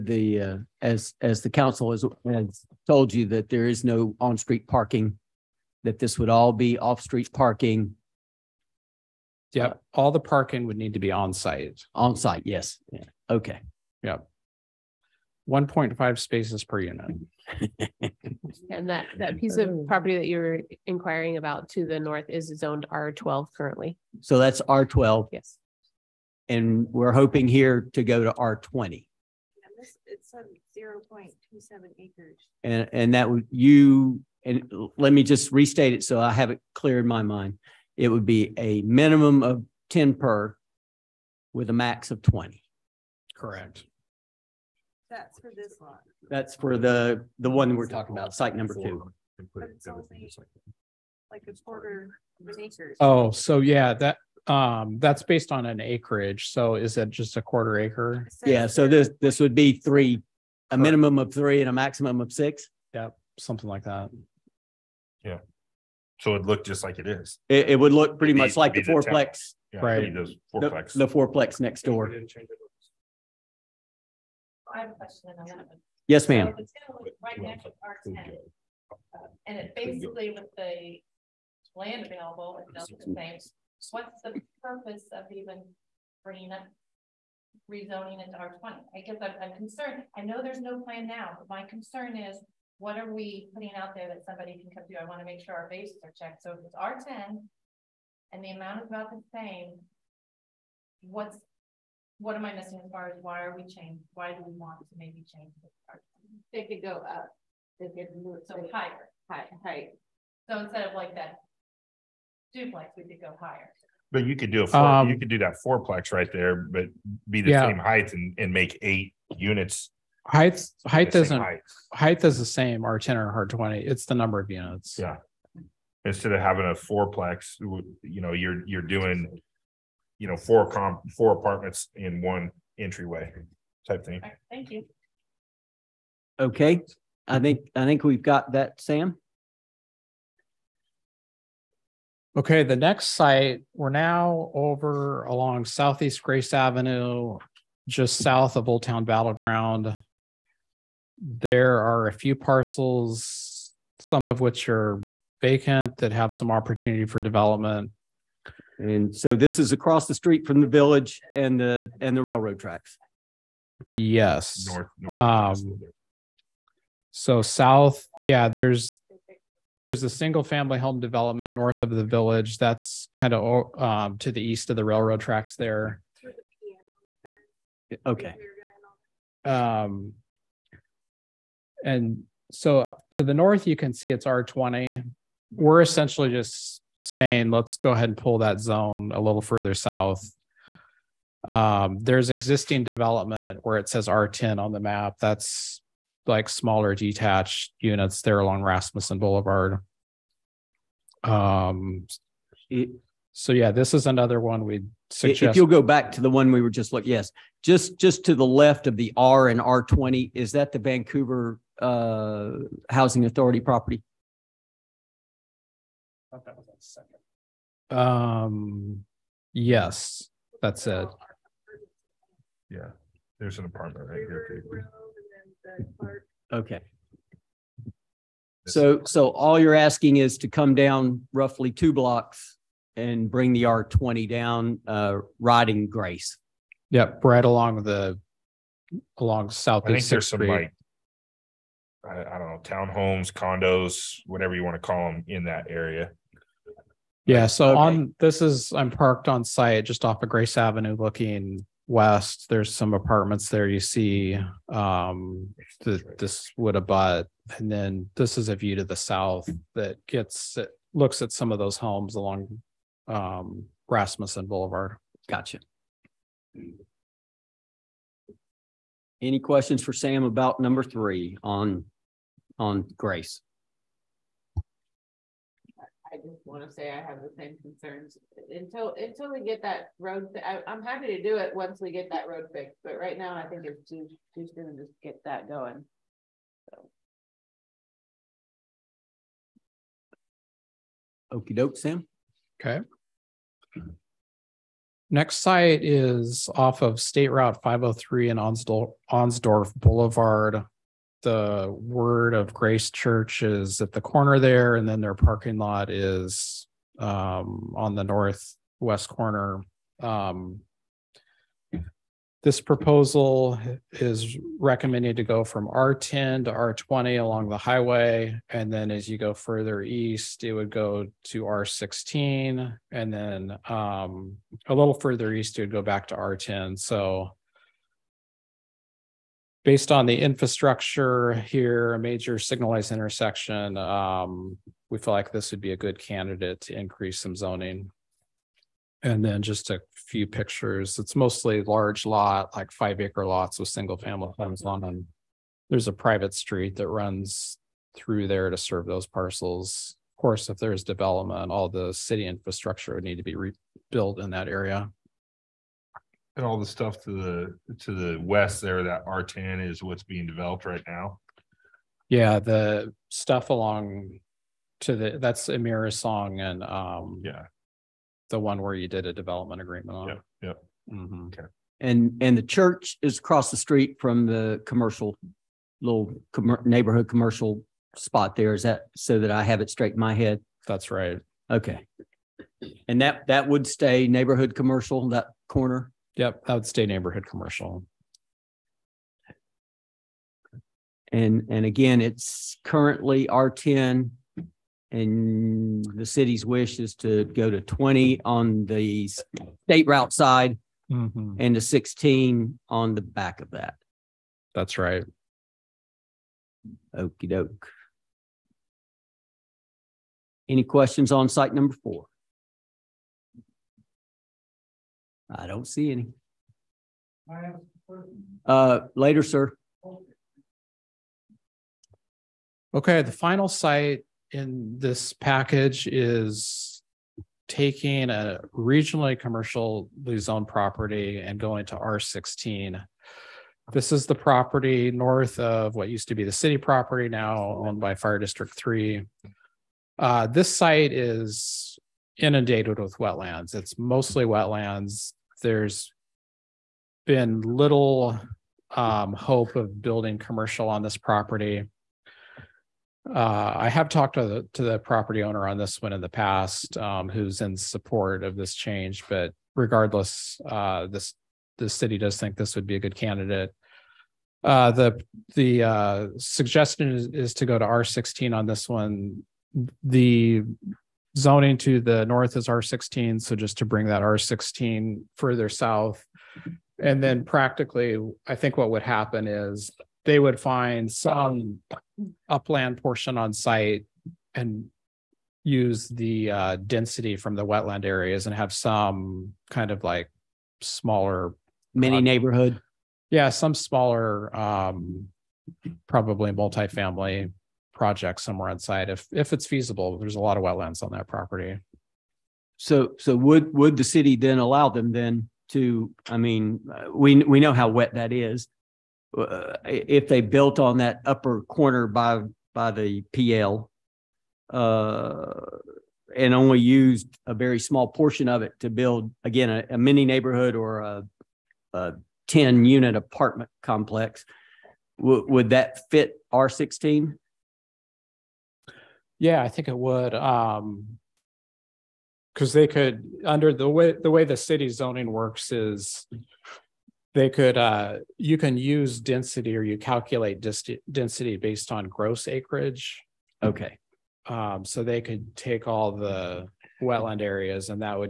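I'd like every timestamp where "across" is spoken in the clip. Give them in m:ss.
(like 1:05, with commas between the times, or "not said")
2:39, 6:13.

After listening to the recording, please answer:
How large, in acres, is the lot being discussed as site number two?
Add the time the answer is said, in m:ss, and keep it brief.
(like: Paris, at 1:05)
0.27 acres, at 0:30.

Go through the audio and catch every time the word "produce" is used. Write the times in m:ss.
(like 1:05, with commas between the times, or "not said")
not said.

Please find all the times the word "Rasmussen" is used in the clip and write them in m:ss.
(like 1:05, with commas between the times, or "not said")
3:18, 4:23.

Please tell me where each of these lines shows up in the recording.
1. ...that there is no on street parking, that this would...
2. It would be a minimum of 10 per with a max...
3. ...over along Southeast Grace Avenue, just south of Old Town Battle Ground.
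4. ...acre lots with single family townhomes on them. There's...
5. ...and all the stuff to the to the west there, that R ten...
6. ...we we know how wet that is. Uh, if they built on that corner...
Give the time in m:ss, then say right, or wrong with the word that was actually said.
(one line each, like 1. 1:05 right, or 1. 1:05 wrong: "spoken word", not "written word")
1. 0:03 right
2. 0:37 right
3. 2:24 right
4. 5:43 wrong: "homes", not "townhomes"
5. 5:56 right
6. 8:26 wrong: "upper", not "corner".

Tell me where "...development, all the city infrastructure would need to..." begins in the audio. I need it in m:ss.
5:50.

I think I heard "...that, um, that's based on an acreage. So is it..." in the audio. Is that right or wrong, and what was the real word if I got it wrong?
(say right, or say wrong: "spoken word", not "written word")
right.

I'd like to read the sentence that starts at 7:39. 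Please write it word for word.
But regardless, uh, this the city does think this would be a good candidate.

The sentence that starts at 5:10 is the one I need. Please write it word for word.
Um, this proposal is recommended to go from R10 to R20 along the highway.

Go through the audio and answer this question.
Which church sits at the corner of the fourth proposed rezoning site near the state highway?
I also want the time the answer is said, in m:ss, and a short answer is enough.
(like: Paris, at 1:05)
Word of Grace Church, at 5:01.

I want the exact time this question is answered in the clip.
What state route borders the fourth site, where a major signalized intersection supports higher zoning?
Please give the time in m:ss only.
4:57.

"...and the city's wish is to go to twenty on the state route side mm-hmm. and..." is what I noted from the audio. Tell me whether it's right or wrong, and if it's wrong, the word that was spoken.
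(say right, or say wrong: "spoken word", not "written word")
right.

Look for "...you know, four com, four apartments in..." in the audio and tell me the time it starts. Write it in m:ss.
2:10.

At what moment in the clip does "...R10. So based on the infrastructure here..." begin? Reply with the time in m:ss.
5:26.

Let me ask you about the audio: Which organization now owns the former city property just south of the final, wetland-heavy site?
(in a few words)
Fire District 3.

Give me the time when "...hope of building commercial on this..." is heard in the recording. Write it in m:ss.
7:29.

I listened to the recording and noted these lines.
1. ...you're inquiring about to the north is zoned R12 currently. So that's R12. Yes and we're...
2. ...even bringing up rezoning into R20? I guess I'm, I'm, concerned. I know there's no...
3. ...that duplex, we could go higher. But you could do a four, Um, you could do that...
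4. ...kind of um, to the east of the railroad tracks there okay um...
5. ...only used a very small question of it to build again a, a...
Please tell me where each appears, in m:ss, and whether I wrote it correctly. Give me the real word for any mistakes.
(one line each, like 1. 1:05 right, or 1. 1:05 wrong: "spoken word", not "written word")
1. 0:20 right
2. 1:25 right
3. 1:51 right
4. 2:53 right
5. 8:36 wrong: "portion", not "question".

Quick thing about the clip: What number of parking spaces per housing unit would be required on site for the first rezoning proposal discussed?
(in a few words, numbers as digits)
1.5.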